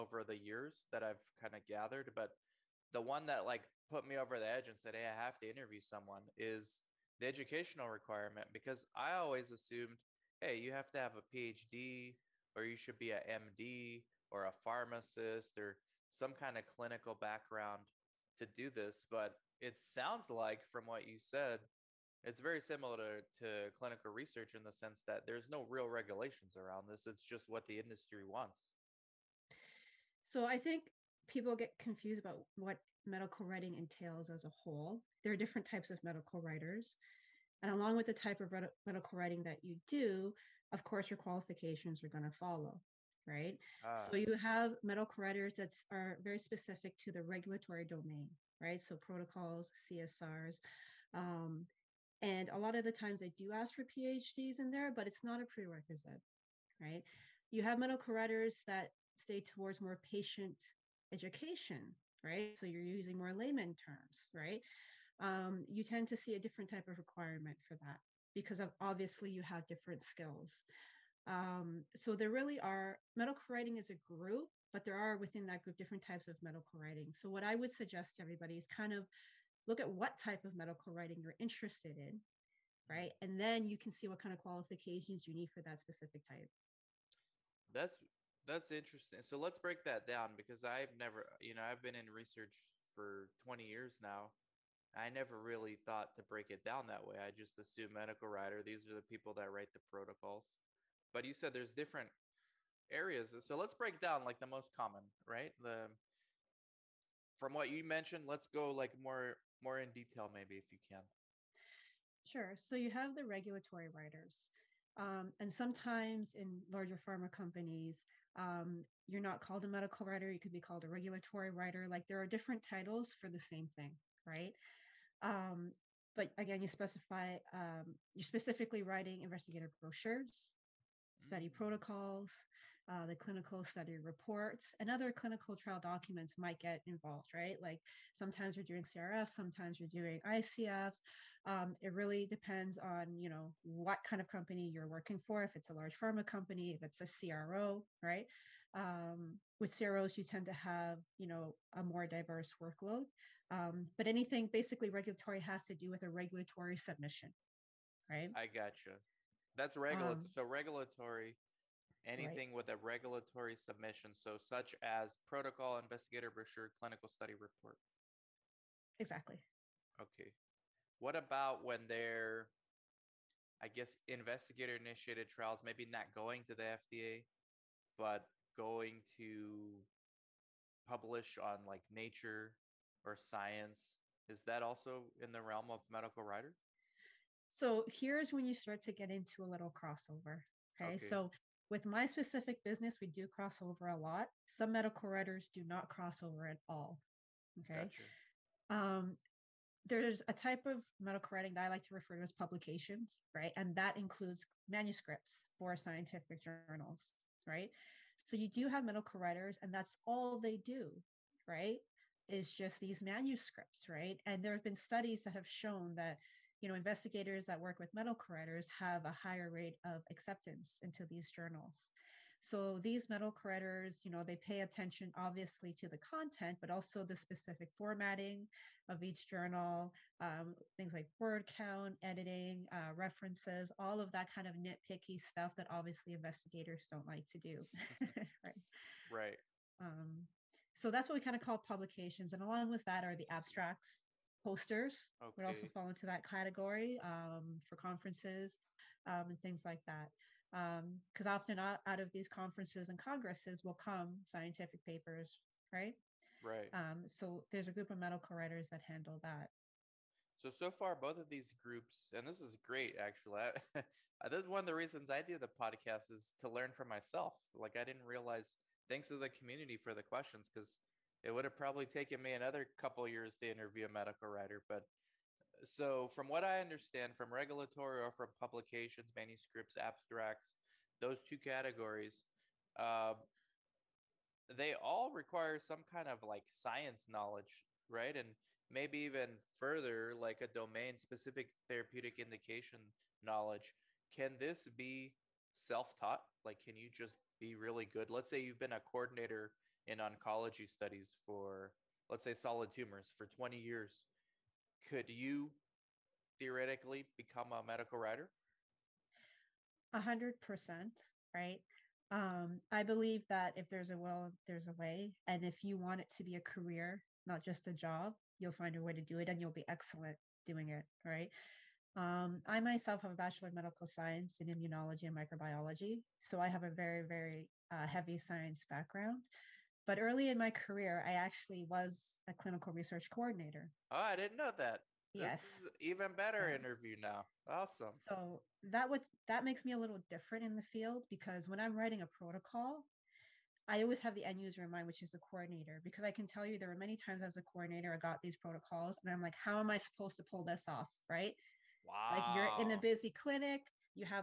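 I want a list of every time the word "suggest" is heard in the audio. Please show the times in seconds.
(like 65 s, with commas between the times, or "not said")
77 s.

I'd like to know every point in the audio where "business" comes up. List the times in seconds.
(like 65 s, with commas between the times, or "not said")
192 s.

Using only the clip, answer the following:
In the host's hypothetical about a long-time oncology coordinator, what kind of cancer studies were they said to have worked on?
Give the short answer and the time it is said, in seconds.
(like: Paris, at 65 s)
Solid tumors, at 302 s.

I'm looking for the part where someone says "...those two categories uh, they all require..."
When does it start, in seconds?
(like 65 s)
280 s.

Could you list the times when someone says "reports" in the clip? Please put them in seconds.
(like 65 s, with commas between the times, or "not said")
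133 s, 167 s.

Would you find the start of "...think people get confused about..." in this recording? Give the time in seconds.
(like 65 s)
30 s.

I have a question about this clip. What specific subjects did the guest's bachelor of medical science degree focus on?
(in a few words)
Immunology and Microbiology.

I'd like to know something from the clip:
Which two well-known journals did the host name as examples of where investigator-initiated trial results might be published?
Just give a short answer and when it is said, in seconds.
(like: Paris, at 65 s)
Nature or Science, at 181 s.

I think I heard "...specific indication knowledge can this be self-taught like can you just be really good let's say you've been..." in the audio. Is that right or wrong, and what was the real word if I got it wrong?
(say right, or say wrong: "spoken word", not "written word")
wrong: "therapeutic", not "specific".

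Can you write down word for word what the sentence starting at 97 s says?
I just assume medical writer, these are the people that write the protocols.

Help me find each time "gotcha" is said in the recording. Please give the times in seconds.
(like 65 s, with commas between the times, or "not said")
158 s, 197 s.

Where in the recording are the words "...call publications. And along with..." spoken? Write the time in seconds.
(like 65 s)
241 s.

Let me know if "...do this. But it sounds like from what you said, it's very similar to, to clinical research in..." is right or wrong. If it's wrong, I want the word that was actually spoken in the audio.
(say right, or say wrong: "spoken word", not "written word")
right.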